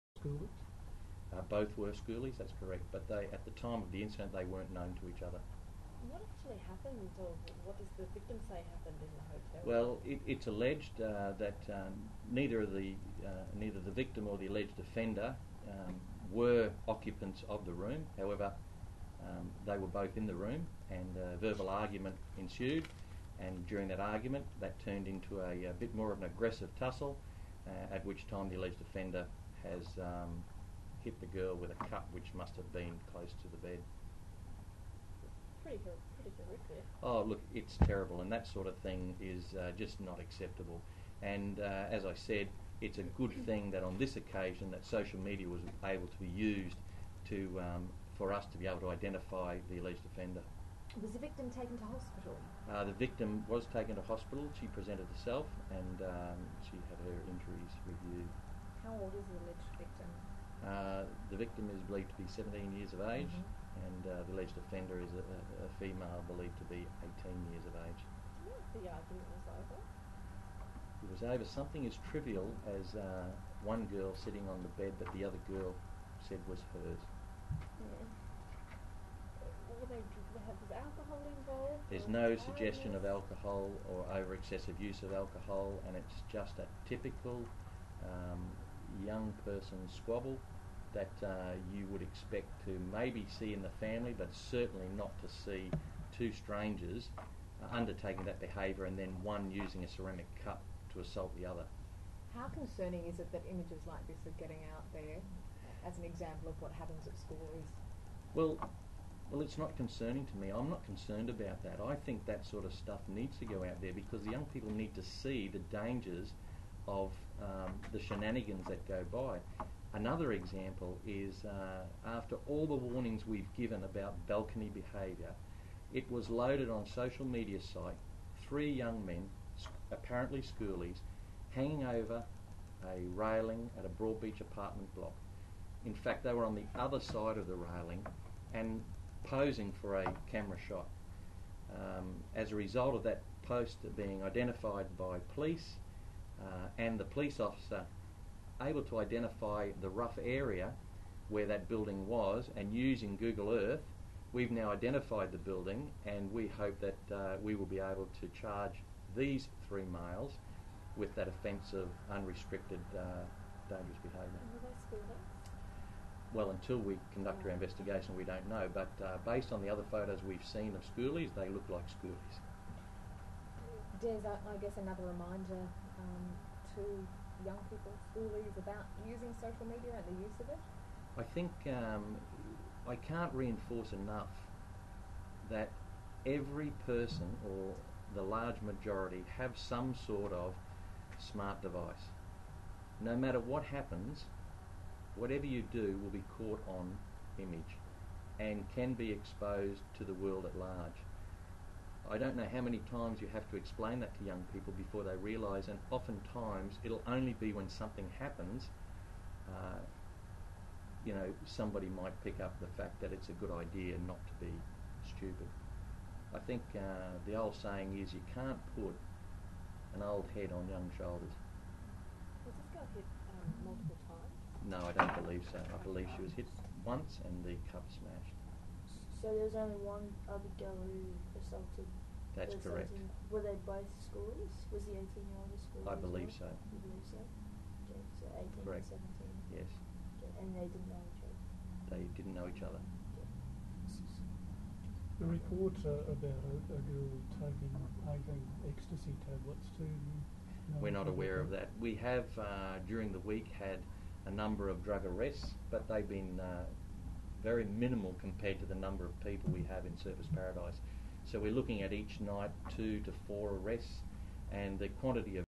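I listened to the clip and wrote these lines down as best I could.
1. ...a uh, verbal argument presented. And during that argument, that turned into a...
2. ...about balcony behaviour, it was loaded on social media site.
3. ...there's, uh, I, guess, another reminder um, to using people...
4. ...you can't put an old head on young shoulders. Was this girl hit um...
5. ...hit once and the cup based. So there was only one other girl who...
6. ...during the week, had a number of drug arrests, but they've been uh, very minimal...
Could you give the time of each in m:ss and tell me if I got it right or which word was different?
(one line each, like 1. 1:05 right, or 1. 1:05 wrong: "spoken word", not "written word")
1. 0:21 wrong: "ensued", not "presented"
2. 2:03 right
3. 2:54 wrong: "young", not "using"
4. 3:38 right
5. 3:46 wrong: "smashed", not "based"
6. 4:12 right.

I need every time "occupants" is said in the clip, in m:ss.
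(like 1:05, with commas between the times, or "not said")
0:16.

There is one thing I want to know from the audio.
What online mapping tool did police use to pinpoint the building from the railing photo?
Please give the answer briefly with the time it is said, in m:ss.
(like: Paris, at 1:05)
Google Earth, at 2:33.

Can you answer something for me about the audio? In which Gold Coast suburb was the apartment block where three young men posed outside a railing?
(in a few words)
Broadbeach.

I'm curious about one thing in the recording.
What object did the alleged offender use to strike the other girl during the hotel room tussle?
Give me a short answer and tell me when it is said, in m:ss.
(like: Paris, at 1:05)
A cup, at 0:31.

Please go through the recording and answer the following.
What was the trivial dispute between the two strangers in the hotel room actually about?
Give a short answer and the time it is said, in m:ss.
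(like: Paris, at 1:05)
Sitting on the bed, at 1:13.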